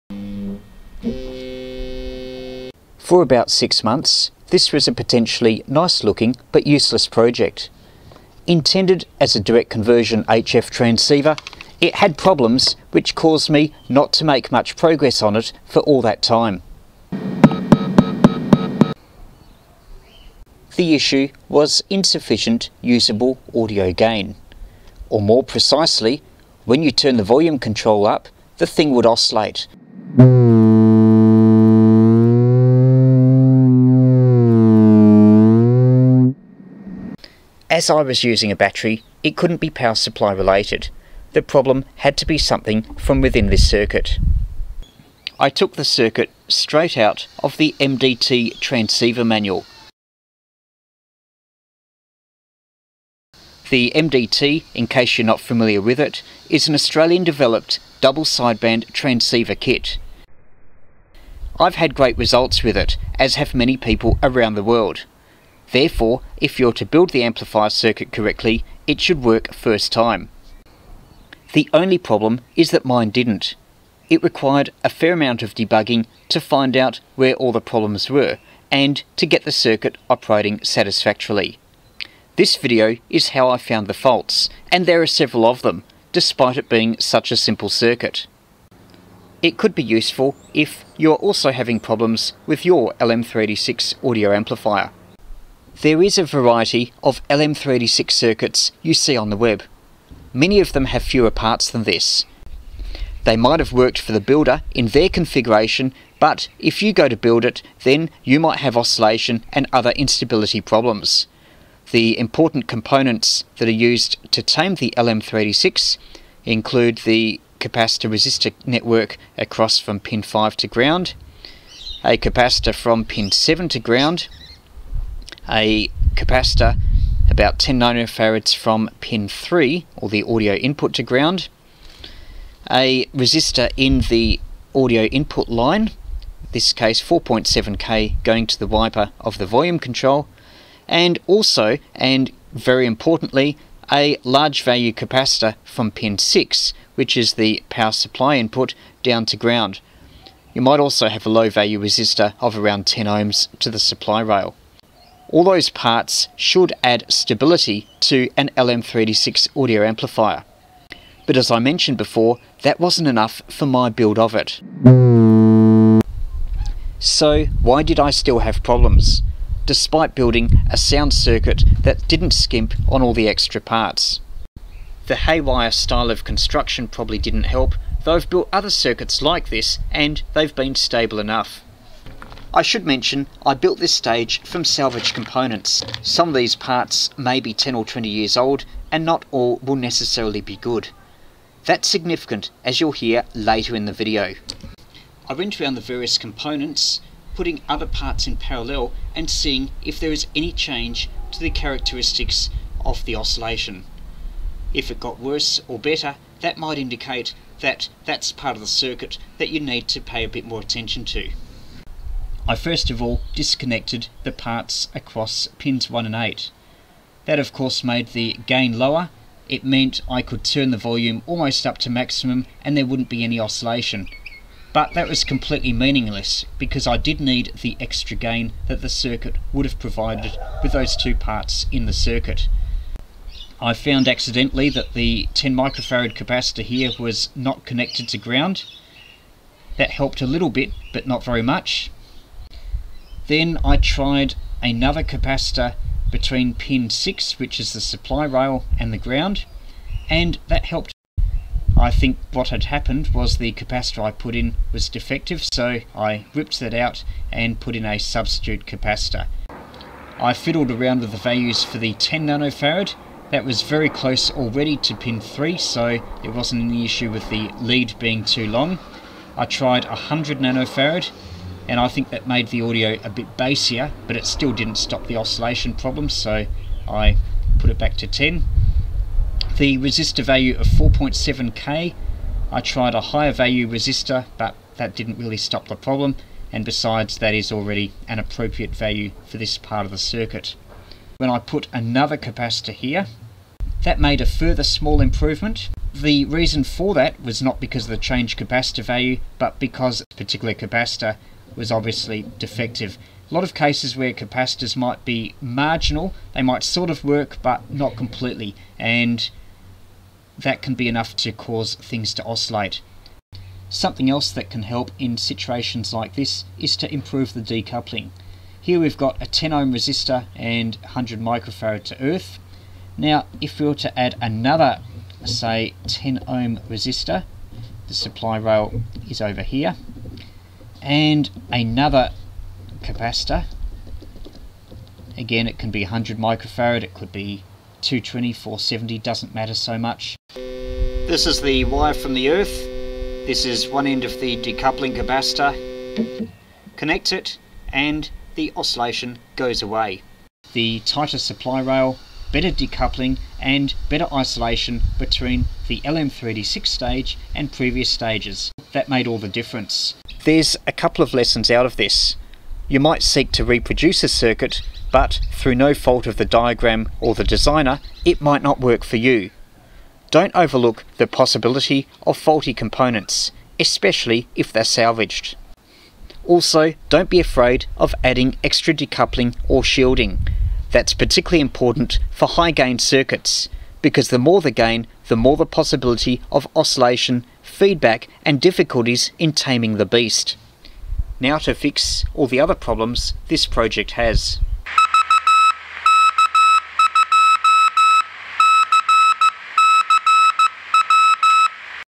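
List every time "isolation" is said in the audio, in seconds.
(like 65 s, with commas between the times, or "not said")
354 s.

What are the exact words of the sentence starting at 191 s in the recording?
That's significant, as you'll hear later in the video.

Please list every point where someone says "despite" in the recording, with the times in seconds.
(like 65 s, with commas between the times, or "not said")
86 s, 169 s.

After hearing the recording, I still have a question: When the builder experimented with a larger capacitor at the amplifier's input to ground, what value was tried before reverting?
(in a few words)
100 nanofarad.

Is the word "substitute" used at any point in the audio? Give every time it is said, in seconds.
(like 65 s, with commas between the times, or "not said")
257 s.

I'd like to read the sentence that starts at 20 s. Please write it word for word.
The issue was insufficient usable audio gain.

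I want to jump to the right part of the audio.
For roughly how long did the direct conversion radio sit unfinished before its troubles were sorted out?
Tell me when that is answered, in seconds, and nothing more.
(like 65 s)
3 s.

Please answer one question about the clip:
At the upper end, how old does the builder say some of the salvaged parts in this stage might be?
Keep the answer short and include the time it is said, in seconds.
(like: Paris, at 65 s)
20 years, at 187 s.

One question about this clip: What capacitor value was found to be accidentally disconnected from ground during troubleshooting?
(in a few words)
10 microfarad.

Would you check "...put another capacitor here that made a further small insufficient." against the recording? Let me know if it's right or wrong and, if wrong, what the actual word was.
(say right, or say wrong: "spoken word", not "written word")
wrong: "improvement", not "insufficient".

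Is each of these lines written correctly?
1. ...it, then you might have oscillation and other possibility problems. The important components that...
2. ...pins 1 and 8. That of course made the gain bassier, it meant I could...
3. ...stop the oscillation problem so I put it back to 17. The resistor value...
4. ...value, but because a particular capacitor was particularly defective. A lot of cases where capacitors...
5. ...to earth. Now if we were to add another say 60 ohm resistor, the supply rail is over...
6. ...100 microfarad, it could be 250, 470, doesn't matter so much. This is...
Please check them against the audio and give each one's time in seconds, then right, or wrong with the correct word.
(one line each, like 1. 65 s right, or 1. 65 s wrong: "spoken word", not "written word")
1. 107 s wrong: "instability", not "possibility"
2. 215 s wrong: "lower", not "bassier"
3. 274 s wrong: "10", not "17"
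4. 298 s wrong: "obviously", not "particularly"
5. 321 s wrong: "10", not "60"
6. 335 s wrong: "220", not "250".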